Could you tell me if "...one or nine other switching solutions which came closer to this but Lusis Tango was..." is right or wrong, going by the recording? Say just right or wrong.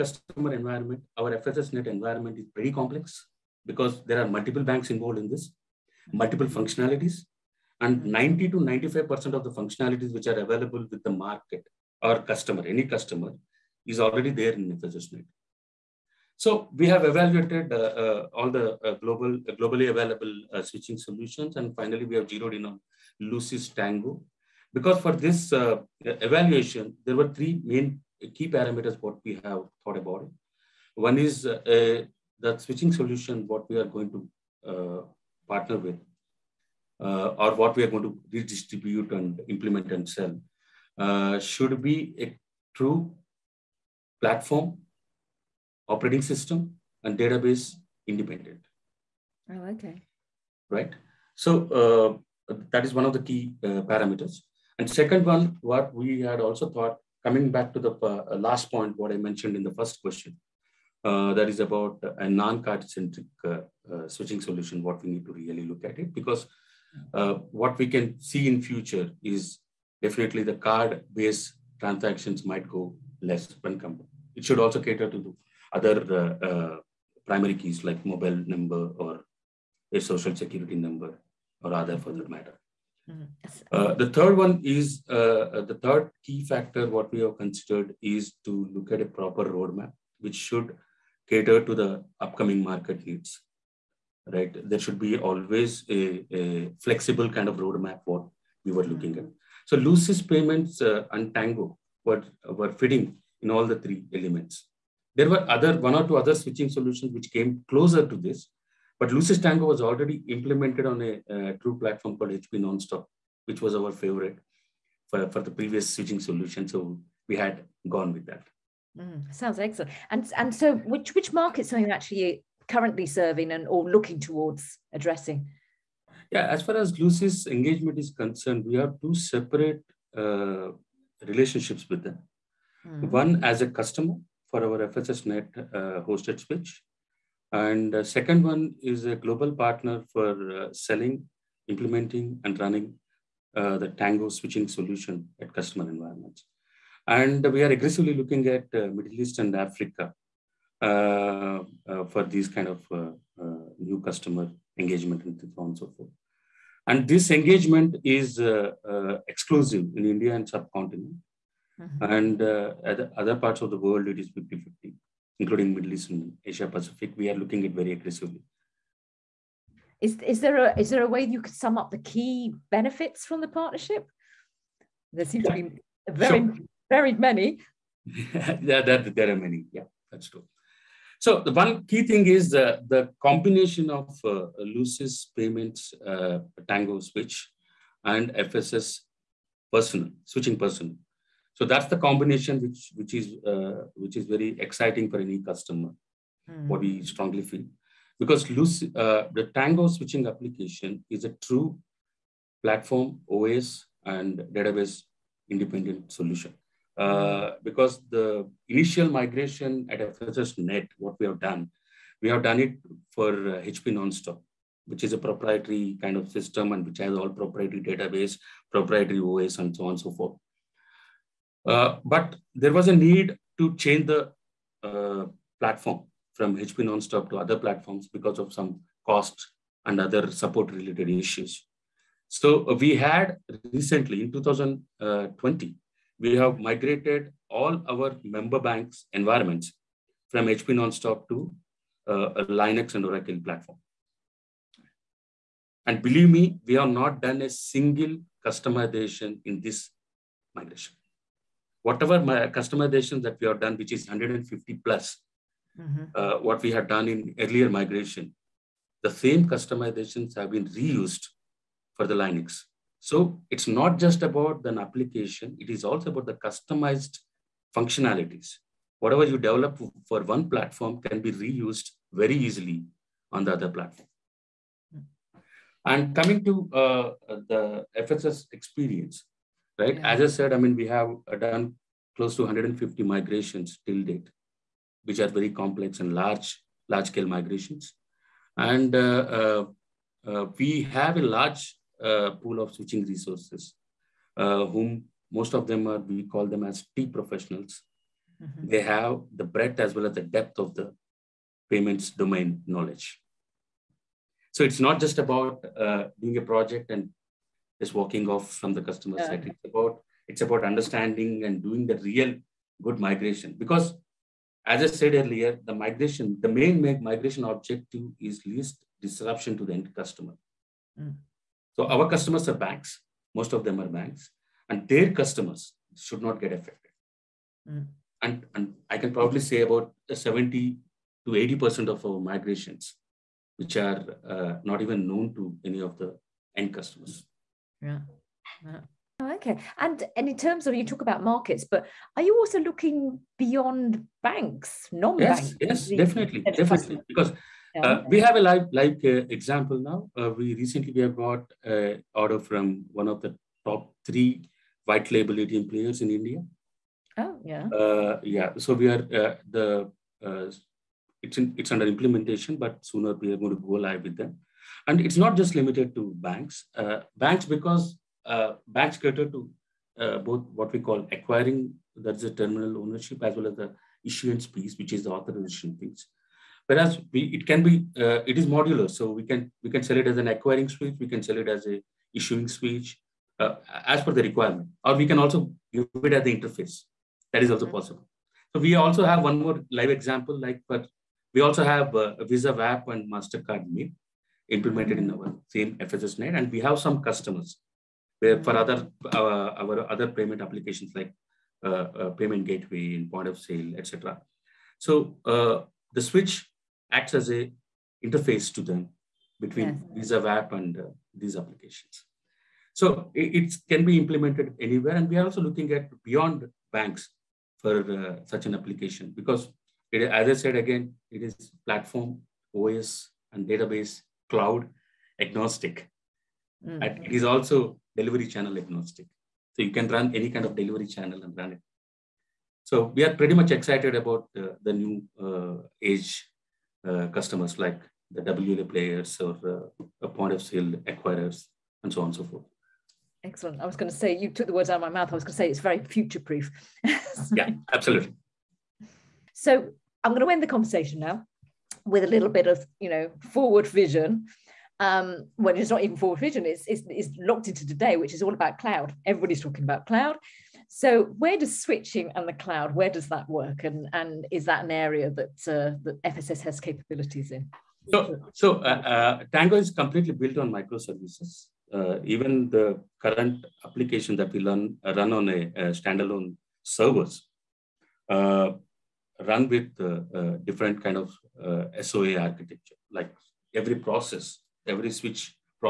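wrong.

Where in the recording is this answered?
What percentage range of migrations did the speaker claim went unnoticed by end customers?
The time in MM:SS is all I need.
05:30.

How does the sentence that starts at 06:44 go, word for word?
So uh, the switch acts as a interface to them between yes.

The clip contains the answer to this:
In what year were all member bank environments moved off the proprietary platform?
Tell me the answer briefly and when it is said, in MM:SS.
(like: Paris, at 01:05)
2020, at 03:54.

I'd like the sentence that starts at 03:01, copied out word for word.
So the one key thing is the, the combination of uh, Lusis payments, uh, Tango switch, and FSS personal, switching personal.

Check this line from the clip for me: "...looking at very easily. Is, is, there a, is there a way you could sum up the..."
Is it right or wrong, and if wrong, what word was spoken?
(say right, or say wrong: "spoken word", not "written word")
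wrong: "aggressively", not "easily".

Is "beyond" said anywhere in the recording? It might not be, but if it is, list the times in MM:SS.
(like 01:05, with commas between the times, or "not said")
05:43, 06:56.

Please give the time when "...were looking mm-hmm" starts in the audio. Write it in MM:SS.
01:38.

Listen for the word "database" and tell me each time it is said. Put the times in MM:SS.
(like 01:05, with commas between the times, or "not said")
00:47, 03:24, 03:37, 07:03.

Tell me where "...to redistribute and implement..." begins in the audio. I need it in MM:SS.
00:38.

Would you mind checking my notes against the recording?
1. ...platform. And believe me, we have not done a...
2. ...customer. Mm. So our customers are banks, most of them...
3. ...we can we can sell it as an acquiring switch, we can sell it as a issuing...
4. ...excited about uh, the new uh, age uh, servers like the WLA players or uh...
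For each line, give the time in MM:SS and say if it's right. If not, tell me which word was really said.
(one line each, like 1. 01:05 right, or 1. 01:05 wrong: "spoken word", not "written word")
1. 04:03 right
2. 05:19 right
3. 06:19 right
4. 07:13 wrong: "customers", not "servers".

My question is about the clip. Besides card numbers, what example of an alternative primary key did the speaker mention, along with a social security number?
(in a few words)
mobile number.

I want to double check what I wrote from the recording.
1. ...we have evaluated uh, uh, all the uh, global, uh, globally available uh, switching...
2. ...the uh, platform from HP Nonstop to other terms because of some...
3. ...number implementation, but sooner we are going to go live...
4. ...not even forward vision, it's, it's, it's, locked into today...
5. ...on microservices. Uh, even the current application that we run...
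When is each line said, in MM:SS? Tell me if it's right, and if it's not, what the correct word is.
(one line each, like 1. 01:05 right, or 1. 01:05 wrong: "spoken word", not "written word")
1. 00:16 right
2. 03:44 wrong: "platforms", not "terms"
3. 06:01 wrong: "under", not "number"
4. 07:35 right
5. 07:50 right.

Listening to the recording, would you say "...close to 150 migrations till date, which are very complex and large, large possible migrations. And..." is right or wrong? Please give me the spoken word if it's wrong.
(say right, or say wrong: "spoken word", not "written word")
wrong: "scale", not "possible".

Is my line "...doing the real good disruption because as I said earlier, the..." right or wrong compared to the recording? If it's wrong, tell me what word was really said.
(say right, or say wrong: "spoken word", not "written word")
wrong: "migration", not "disruption".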